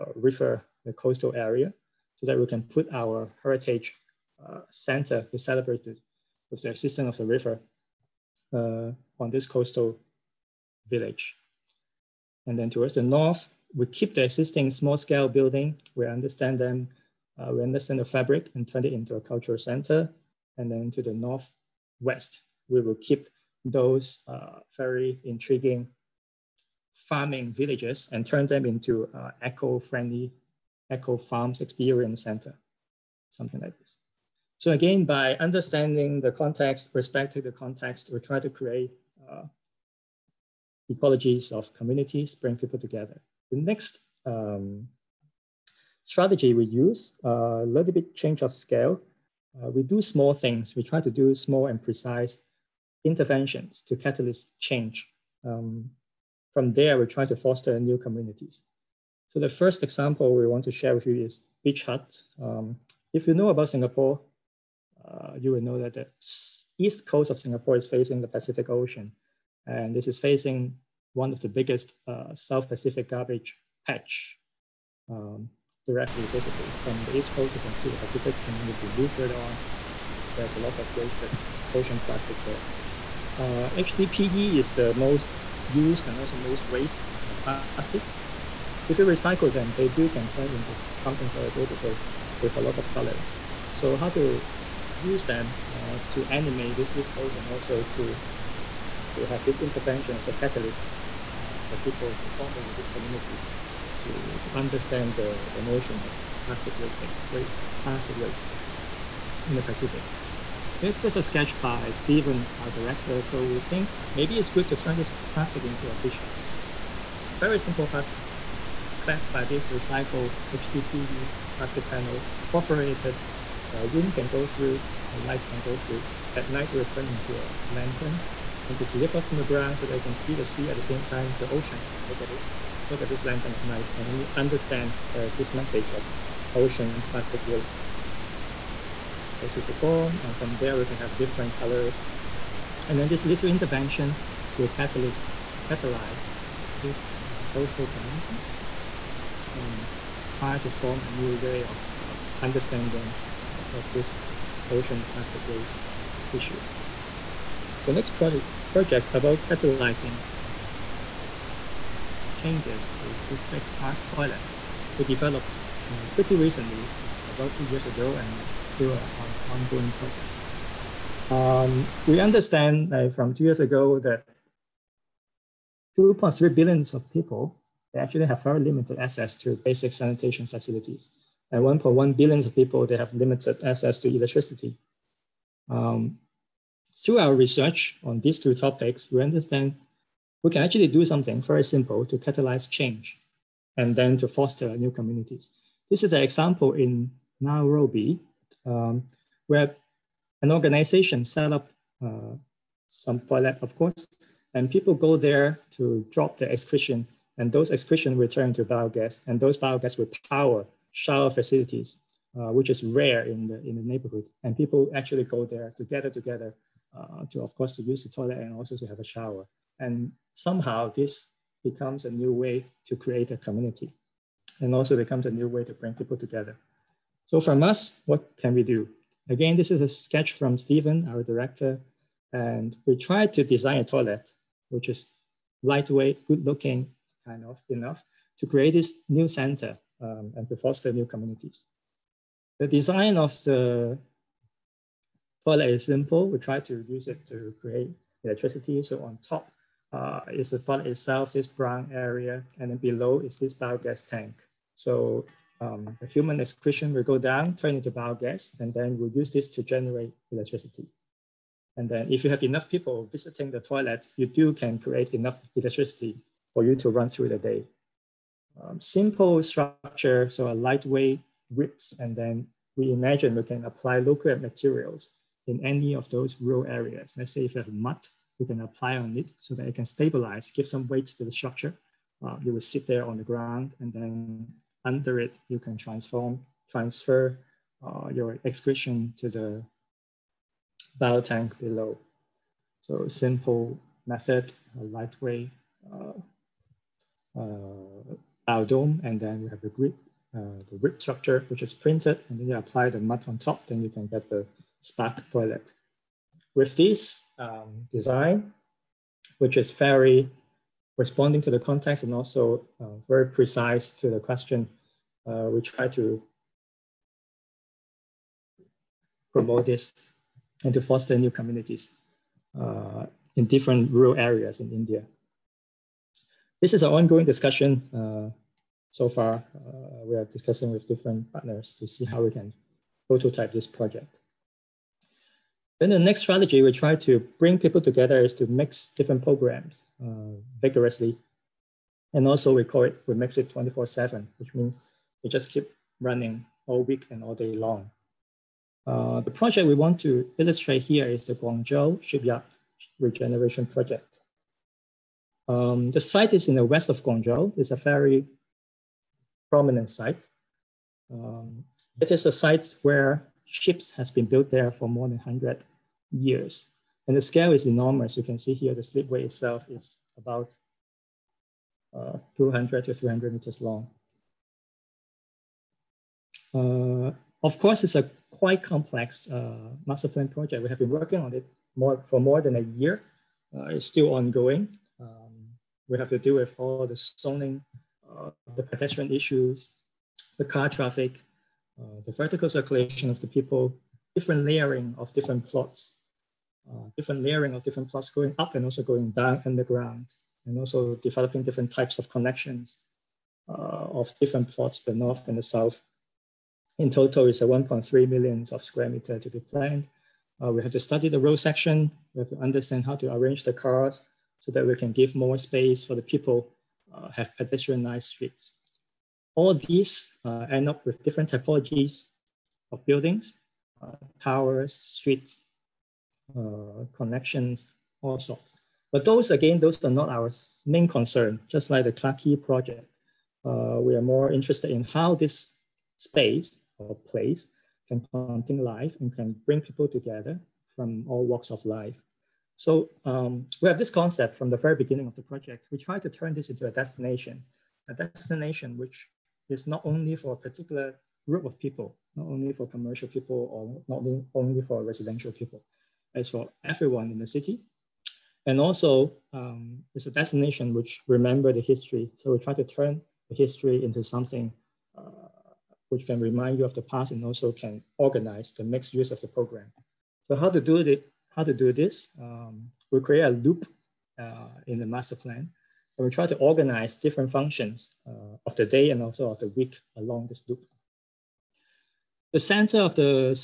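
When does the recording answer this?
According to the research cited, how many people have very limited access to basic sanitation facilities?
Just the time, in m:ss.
2:55.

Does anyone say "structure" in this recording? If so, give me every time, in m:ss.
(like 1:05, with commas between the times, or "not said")
4:29, 4:41, 5:01.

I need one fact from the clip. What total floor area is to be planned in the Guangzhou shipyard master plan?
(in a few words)
1.3 million square meters.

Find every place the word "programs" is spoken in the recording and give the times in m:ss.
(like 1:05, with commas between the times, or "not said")
5:39, 7:49.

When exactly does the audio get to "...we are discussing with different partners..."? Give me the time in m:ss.
5:30.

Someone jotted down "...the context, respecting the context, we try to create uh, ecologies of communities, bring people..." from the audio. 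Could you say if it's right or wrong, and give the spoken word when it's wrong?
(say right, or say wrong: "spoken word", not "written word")
right.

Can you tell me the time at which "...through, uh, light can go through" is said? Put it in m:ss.
2:04.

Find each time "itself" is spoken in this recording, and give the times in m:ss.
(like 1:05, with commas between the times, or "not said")
4:10, 6:09.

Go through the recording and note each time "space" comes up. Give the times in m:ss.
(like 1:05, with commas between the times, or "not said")
6:55, 7:15.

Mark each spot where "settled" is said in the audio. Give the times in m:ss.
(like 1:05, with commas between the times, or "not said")
not said.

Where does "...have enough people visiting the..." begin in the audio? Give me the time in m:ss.
4:22.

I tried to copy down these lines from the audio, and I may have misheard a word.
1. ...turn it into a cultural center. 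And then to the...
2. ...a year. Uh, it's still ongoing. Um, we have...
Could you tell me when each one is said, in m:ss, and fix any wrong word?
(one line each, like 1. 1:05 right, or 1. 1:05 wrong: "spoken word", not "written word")
1. 0:18 right
2. 6:22 right.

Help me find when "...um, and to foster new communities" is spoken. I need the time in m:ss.
4:00.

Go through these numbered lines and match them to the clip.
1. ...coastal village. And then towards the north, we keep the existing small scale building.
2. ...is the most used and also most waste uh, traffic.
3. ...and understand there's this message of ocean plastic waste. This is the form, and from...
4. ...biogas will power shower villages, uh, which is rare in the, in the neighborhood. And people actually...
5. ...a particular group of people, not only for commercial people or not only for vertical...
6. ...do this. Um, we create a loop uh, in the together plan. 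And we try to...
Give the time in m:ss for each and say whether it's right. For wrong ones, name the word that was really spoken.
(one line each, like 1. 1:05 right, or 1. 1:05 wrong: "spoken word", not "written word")
1. 0:09 right
2. 1:24 wrong: "plastic", not "traffic"
3. 2:13 right
4. 3:29 wrong: "facilities", not "villages"
5. 7:30 wrong: "residential", not "vertical"
6. 7:51 wrong: "master", not "together".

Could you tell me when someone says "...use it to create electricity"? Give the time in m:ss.
4:06.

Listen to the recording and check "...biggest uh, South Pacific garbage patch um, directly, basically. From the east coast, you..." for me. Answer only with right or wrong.
right.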